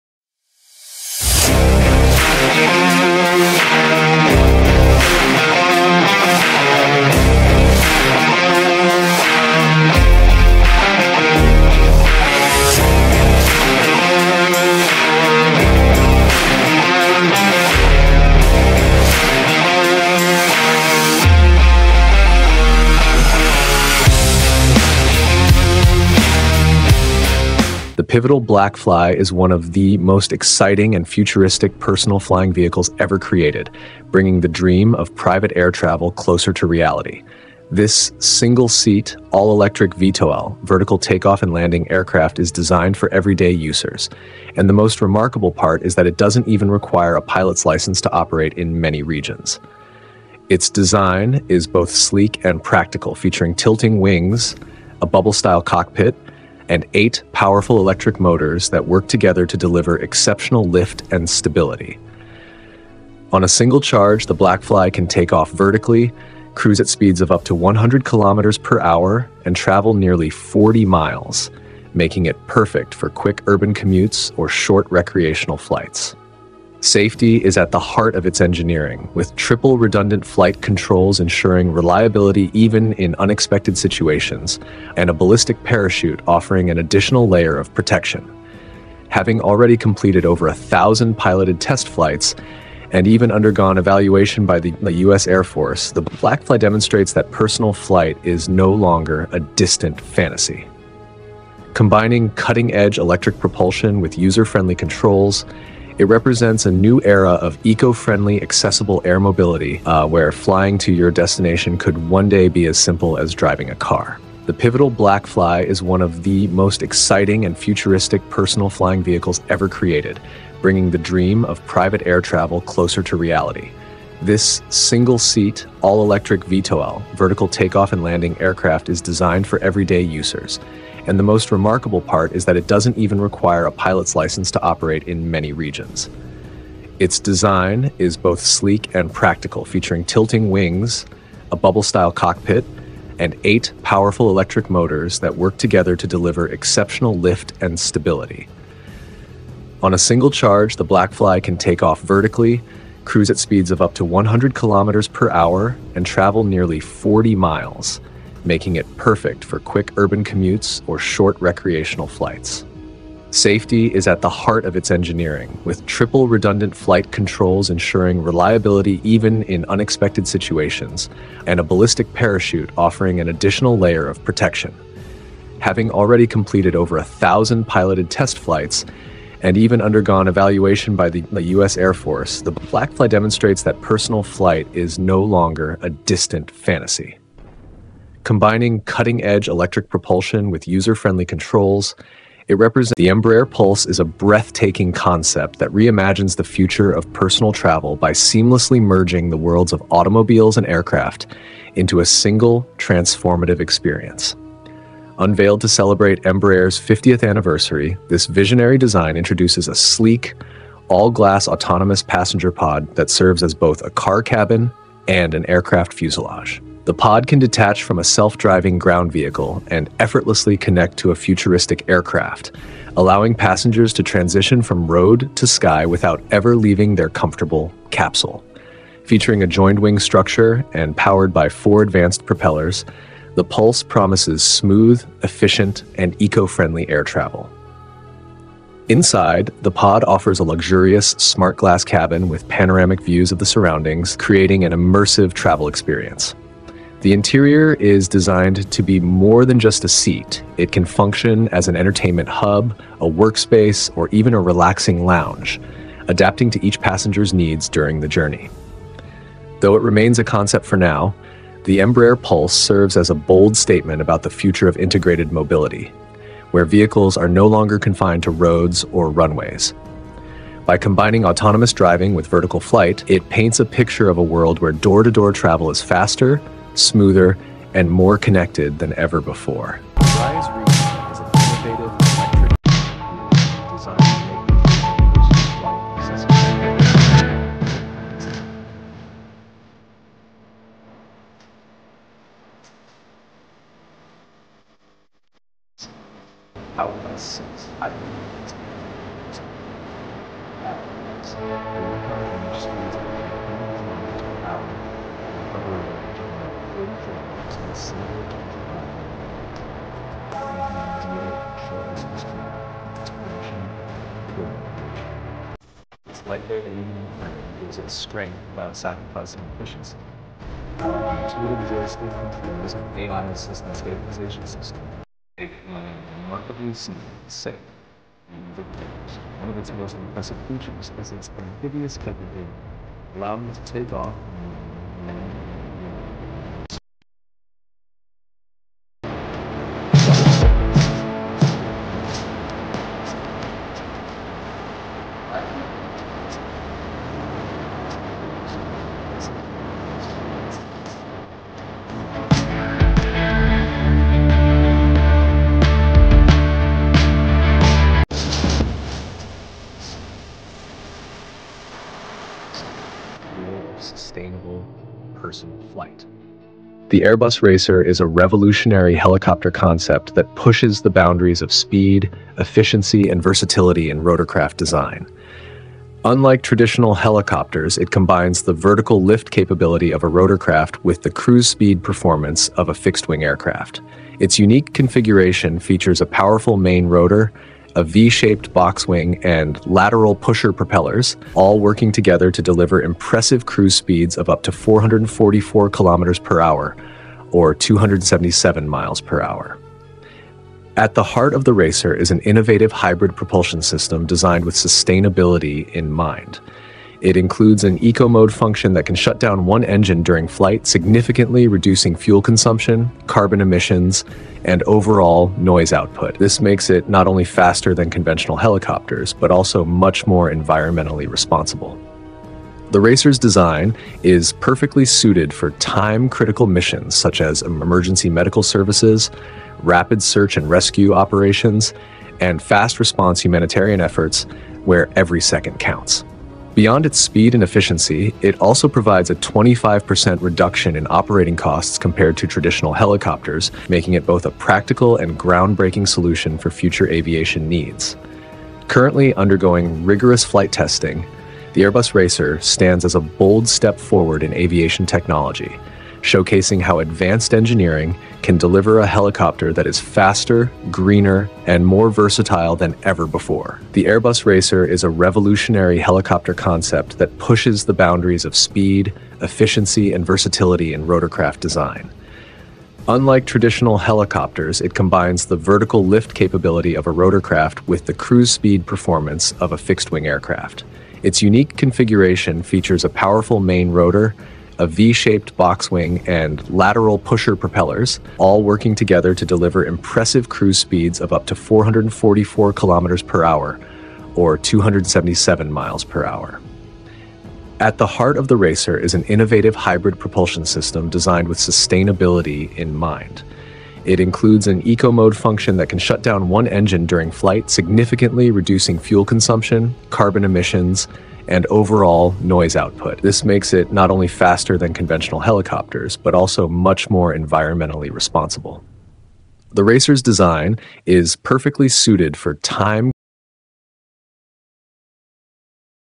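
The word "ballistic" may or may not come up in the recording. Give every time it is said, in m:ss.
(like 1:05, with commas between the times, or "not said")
1:25, 2:51.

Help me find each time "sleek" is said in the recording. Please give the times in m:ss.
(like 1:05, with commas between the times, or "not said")
0:51, 2:18, 3:29.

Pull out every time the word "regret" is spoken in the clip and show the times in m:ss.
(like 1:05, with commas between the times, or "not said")
not said.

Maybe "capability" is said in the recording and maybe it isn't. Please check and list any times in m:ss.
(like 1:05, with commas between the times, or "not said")
5:31, 6:19, 7:56.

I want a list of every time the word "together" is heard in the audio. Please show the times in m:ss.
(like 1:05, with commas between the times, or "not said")
0:59, 2:25, 6:31, 8:08.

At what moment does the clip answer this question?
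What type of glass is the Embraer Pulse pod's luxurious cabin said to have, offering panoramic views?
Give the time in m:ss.
4:01.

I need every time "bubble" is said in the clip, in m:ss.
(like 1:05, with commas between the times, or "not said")
0:55, 2:21.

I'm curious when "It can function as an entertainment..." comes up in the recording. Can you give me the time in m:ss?
4:10.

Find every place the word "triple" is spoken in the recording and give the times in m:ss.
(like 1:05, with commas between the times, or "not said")
1:19, 2:45.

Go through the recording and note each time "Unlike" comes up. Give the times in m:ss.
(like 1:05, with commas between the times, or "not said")
6:16, 7:52.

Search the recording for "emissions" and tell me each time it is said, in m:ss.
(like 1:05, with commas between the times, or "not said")
6:53, 8:30.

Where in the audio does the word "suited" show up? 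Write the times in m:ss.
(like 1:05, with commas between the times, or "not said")
7:04, 8:41.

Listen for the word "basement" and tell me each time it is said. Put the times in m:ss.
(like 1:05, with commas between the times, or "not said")
not said.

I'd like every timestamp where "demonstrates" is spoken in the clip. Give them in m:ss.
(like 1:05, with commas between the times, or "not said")
1:36, 3:03.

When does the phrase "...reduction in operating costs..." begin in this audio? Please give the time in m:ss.
7:20.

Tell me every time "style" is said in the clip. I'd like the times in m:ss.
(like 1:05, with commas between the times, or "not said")
0:55, 2:21.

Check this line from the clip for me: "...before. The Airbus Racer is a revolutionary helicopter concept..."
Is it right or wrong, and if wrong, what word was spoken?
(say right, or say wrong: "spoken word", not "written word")
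right.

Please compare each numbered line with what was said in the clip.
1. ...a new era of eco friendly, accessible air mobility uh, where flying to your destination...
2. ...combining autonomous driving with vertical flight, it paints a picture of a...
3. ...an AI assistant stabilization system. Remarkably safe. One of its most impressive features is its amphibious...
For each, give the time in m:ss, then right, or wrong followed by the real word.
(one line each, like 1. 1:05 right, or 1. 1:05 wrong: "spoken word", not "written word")
1. 1:46 right
2. 4:30 right
3. 5:22 right.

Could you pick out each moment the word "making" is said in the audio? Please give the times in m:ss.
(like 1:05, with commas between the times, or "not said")
1:11, 2:38, 7:23.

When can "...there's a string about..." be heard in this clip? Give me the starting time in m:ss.
5:17.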